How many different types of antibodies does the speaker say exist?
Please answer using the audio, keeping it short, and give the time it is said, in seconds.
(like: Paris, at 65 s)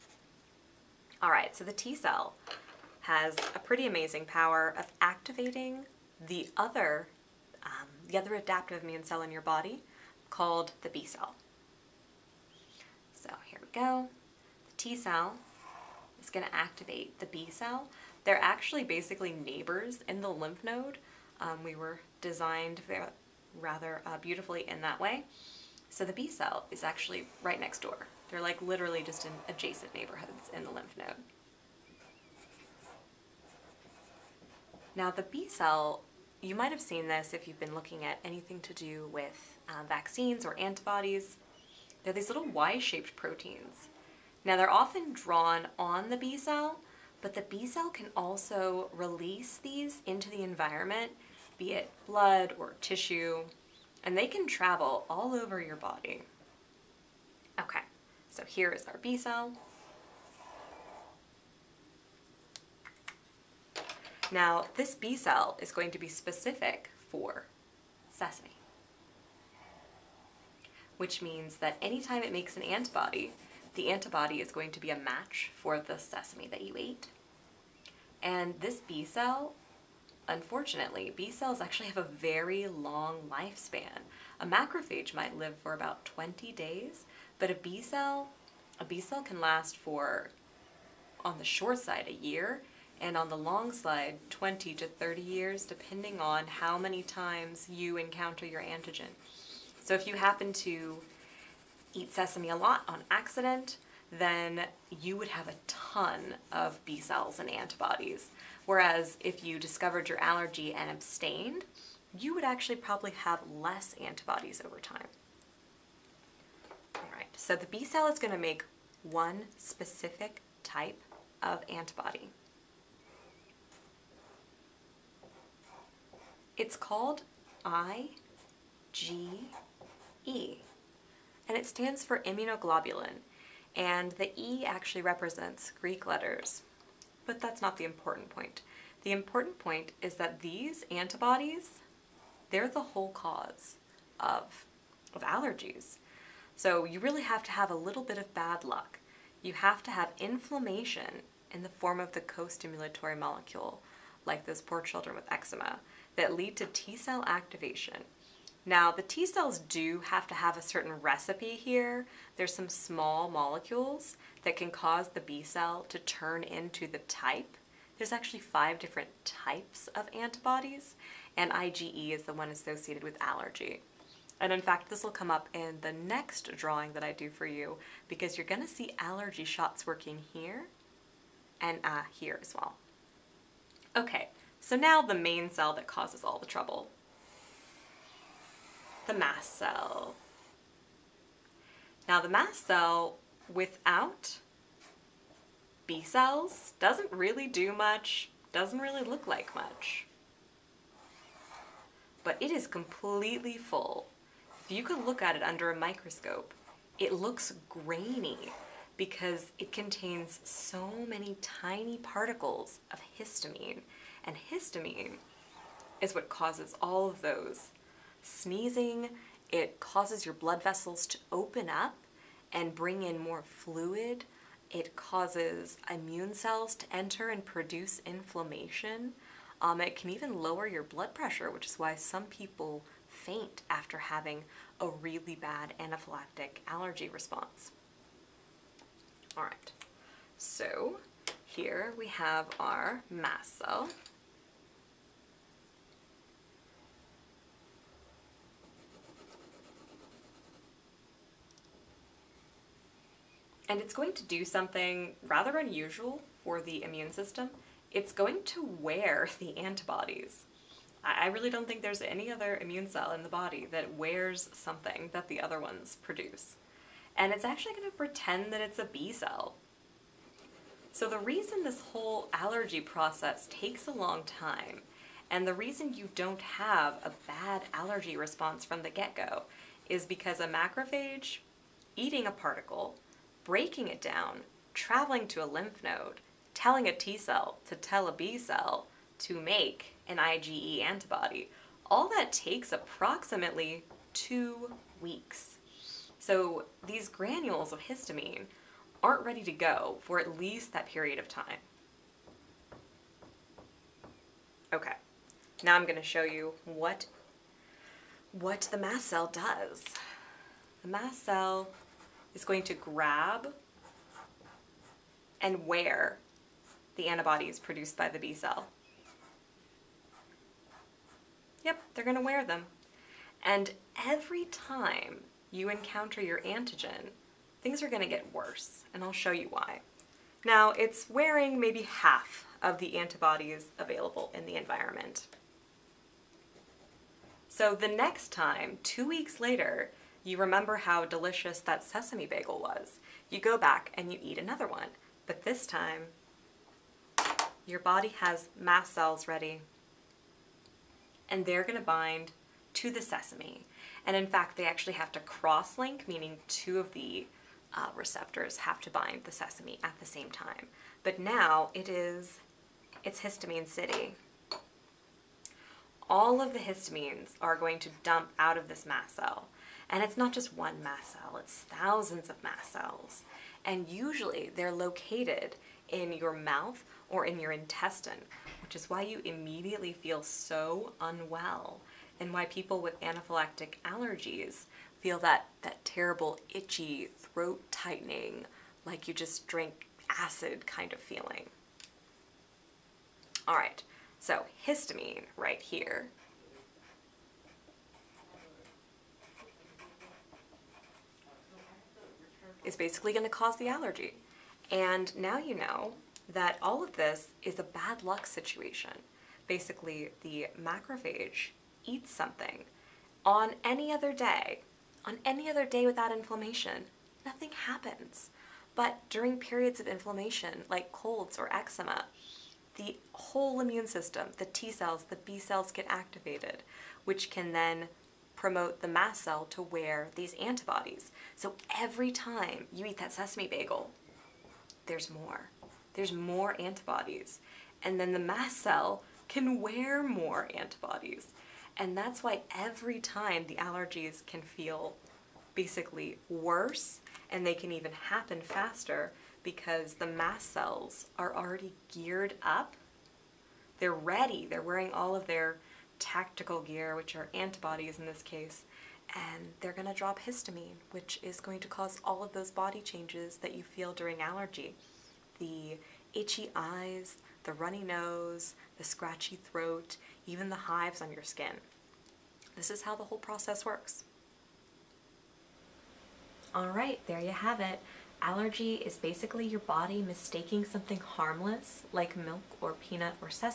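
5, at 168 s.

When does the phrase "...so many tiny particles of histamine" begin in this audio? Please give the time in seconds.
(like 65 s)
210 s.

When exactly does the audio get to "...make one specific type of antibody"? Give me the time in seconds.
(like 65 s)
118 s.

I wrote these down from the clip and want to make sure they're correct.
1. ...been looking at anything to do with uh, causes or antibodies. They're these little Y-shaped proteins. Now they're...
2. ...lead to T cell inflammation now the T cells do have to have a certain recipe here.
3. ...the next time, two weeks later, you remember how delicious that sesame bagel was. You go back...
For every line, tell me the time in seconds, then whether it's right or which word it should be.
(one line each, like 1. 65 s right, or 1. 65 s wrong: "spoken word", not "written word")
1. 37 s wrong: "vaccines", not "causes"
2. 156 s wrong: "activation", not "inflammation"
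3. 337 s right.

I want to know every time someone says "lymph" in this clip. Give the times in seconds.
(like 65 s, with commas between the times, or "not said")
20 s, 30 s, 285 s.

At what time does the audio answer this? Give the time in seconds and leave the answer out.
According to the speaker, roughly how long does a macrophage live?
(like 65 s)
85 s.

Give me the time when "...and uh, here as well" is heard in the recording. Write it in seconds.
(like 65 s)
181 s.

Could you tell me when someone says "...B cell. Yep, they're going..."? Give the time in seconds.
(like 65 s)
318 s.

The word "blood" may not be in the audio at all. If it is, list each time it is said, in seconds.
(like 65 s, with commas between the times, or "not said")
52 s, 220 s, 230 s.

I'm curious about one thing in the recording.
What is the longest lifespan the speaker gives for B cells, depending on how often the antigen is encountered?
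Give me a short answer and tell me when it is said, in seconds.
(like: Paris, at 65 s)
20 to 30 years, at 94 s.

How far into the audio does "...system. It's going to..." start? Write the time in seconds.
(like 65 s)
257 s.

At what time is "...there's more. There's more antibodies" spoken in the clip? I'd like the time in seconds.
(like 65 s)
434 s.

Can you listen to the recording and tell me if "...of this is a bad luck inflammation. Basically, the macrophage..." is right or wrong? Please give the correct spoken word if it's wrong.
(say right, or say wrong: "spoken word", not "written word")
wrong: "situation", not "inflammation".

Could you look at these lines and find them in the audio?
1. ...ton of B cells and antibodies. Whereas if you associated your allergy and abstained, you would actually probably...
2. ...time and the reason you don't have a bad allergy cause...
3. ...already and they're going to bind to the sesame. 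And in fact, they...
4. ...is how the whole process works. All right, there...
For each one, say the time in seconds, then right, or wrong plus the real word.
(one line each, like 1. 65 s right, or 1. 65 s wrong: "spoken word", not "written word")
1. 105 s wrong: "discovered", not "associated"
2. 274 s wrong: "response", not "cause"
3. 349 s wrong: "ready", not "already"
4. 472 s right.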